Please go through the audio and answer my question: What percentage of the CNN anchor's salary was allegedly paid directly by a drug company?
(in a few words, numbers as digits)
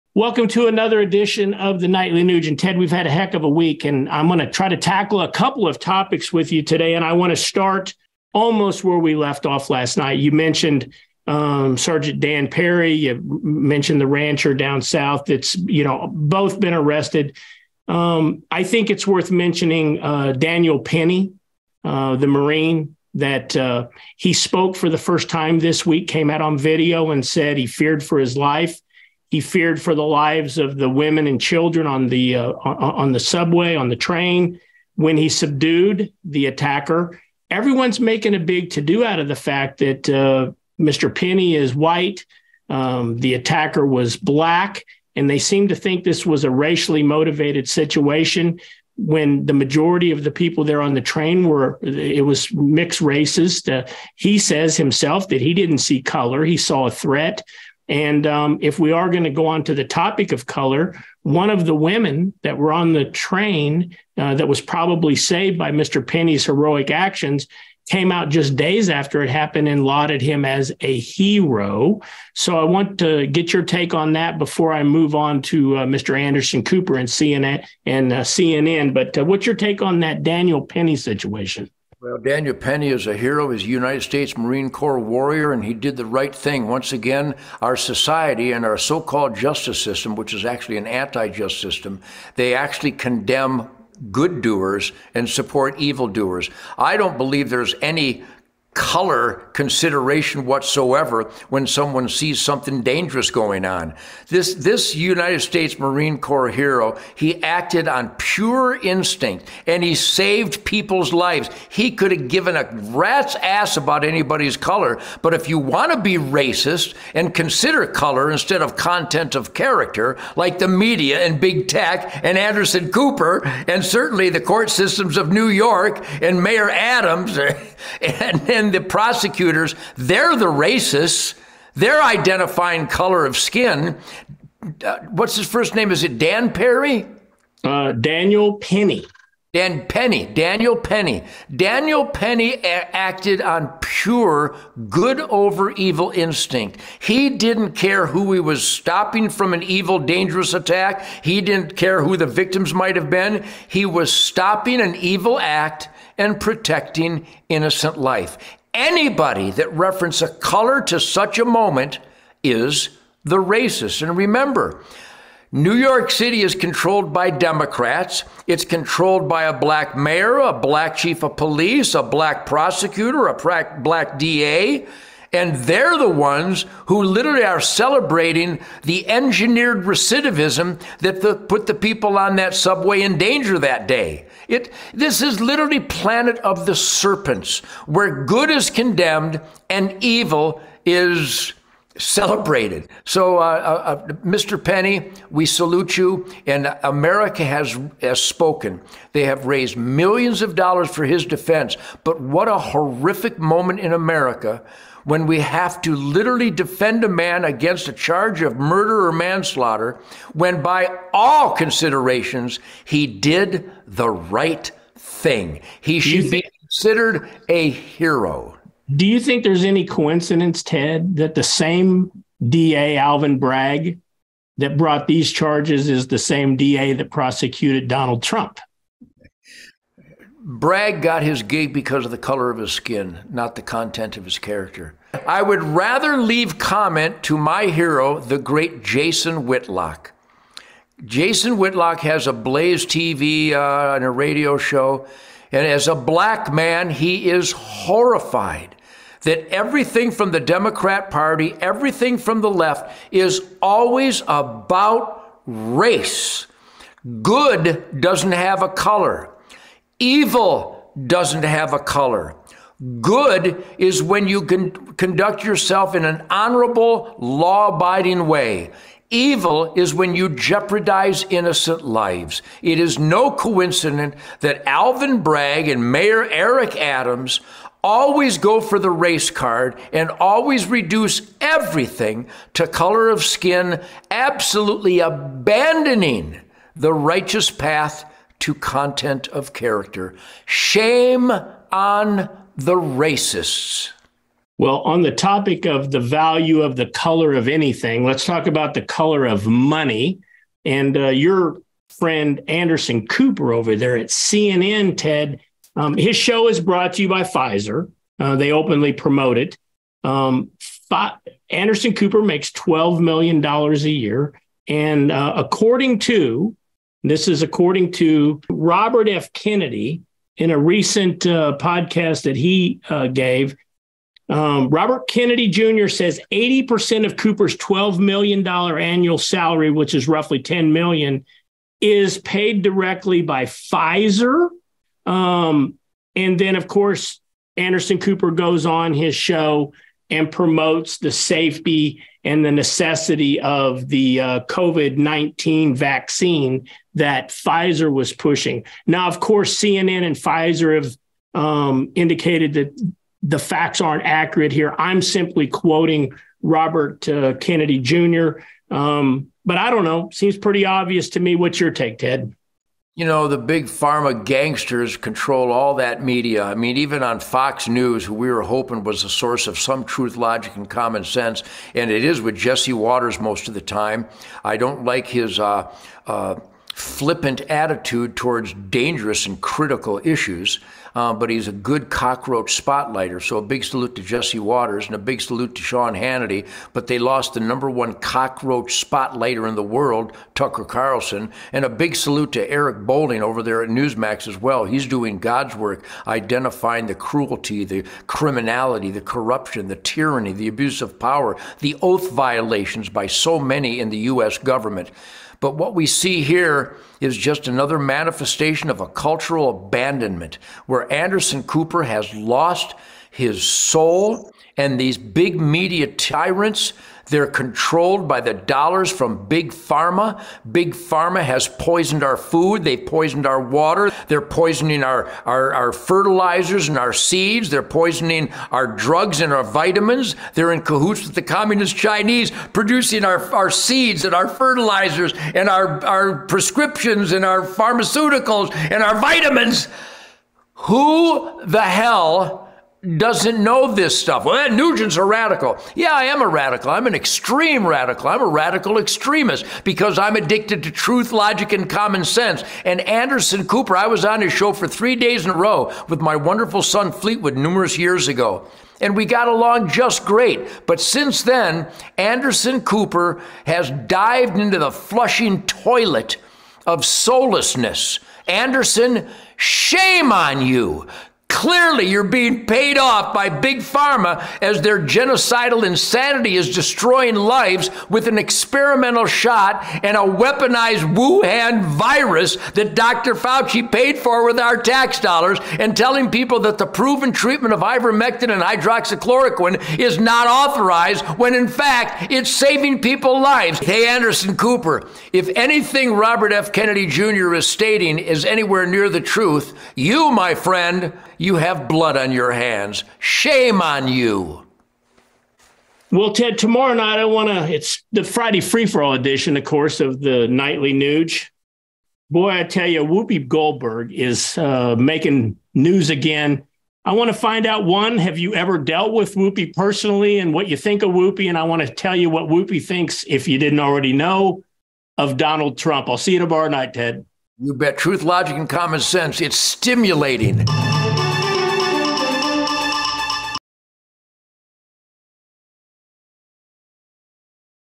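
80%.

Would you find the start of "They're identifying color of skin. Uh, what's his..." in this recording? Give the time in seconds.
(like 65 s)
131 s.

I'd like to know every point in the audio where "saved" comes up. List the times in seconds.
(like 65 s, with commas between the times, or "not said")
65 s, 109 s.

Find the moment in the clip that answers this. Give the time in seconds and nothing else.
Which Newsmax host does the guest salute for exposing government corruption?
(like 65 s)
392 s.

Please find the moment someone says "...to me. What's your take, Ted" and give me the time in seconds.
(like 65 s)
361 s.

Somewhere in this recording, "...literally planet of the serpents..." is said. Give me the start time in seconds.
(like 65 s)
185 s.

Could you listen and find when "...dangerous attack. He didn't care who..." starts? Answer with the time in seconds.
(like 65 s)
149 s.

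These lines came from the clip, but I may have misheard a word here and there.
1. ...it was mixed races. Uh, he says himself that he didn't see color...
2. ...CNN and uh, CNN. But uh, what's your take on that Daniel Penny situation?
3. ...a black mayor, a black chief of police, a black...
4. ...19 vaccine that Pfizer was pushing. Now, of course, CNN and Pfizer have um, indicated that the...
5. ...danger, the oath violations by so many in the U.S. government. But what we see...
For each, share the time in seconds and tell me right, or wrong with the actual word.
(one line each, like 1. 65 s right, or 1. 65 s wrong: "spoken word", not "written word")
1. 51 s right
2. 77 s right
3. 169 s right
4. 344 s right
5. 400 s wrong: "power", not "danger".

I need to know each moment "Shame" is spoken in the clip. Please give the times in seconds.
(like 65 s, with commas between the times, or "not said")
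290 s, 469 s, 502 s.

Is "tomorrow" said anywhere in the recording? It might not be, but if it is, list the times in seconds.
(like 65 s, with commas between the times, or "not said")
506 s, 526 s.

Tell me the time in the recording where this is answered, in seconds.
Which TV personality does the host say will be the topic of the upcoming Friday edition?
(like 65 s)
512 s.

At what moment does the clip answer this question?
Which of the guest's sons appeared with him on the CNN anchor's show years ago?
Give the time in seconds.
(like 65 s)
456 s.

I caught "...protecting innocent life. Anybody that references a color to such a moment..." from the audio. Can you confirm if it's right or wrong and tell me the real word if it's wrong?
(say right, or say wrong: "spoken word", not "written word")
right.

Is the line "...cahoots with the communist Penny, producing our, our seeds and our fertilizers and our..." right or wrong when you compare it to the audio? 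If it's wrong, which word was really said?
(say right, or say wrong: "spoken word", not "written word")
wrong: "Chinese", not "Penny".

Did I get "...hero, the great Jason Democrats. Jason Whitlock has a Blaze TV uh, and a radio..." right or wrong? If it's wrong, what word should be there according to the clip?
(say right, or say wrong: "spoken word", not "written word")
wrong: "Whitlock", not "Democrats".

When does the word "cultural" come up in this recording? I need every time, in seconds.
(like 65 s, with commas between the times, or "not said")
408 s.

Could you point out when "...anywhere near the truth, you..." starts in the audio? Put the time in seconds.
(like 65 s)
498 s.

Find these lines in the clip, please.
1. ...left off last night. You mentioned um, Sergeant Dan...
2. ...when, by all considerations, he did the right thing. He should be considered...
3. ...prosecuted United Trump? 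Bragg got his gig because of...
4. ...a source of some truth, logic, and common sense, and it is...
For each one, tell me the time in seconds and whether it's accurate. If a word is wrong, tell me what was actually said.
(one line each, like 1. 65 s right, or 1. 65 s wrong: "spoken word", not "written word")
1. 9 s right
2. 210 s right
3. 227 s wrong: "Donald", not "United"
4. 369 s right.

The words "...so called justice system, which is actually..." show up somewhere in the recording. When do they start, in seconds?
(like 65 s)
88 s.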